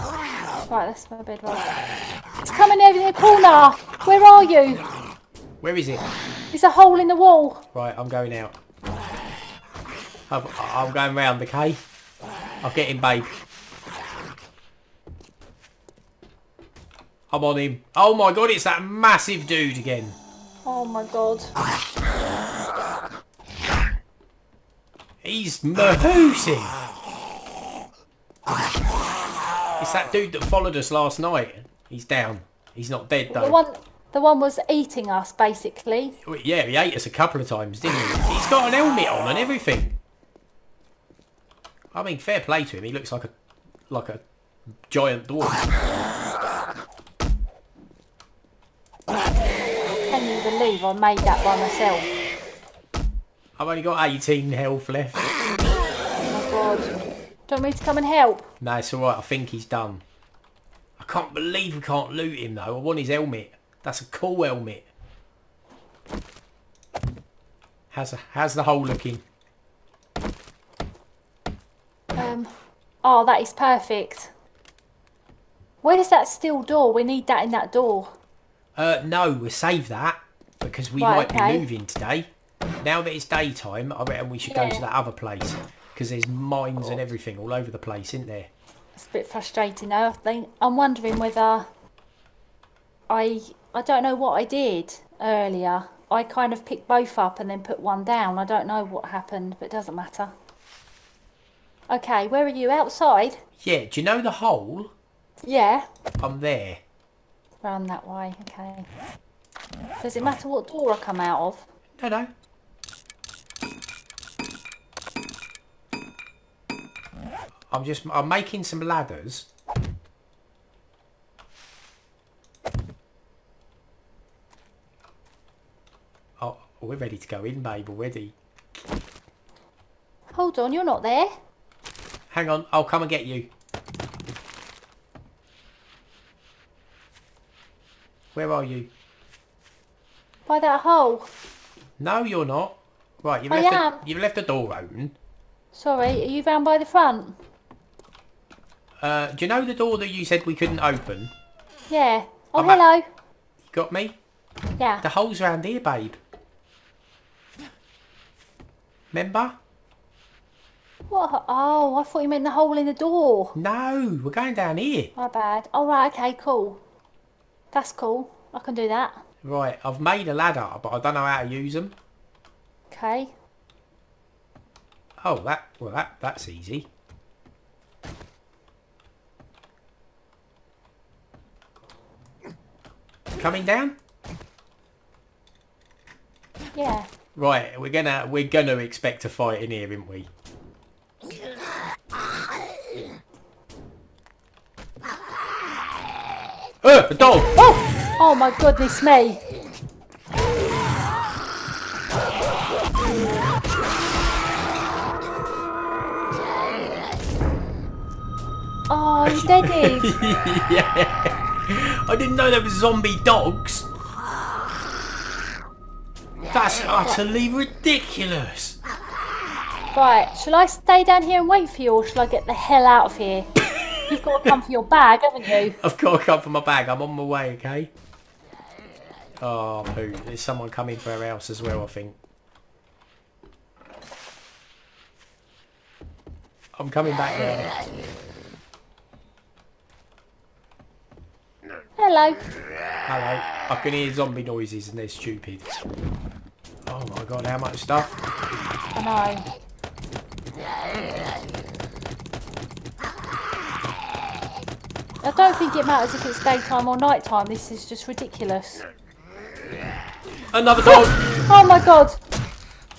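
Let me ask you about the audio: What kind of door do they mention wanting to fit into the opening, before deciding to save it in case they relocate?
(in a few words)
steel door.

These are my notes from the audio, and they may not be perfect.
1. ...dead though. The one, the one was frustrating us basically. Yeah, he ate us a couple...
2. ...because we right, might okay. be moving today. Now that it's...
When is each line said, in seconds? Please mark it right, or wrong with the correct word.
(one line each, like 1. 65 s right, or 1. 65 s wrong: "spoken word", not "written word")
1. 33 s wrong: "eating", not "frustrating"
2. 80 s right.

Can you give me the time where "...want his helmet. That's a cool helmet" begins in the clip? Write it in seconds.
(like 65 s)
62 s.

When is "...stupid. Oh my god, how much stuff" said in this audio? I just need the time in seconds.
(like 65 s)
245 s.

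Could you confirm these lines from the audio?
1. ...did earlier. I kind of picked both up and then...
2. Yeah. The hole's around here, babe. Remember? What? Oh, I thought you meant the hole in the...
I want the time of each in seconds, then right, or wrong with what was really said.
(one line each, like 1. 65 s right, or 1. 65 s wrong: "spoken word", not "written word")
1. 94 s right
2. 154 s right.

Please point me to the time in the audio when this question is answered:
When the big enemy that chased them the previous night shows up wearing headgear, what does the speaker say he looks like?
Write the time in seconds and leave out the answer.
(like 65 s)
44 s.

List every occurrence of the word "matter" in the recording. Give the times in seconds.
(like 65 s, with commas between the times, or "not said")
99 s, 110 s, 255 s.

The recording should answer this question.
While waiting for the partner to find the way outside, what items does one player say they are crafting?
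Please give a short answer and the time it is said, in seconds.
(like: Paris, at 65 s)
ladders, at 118 s.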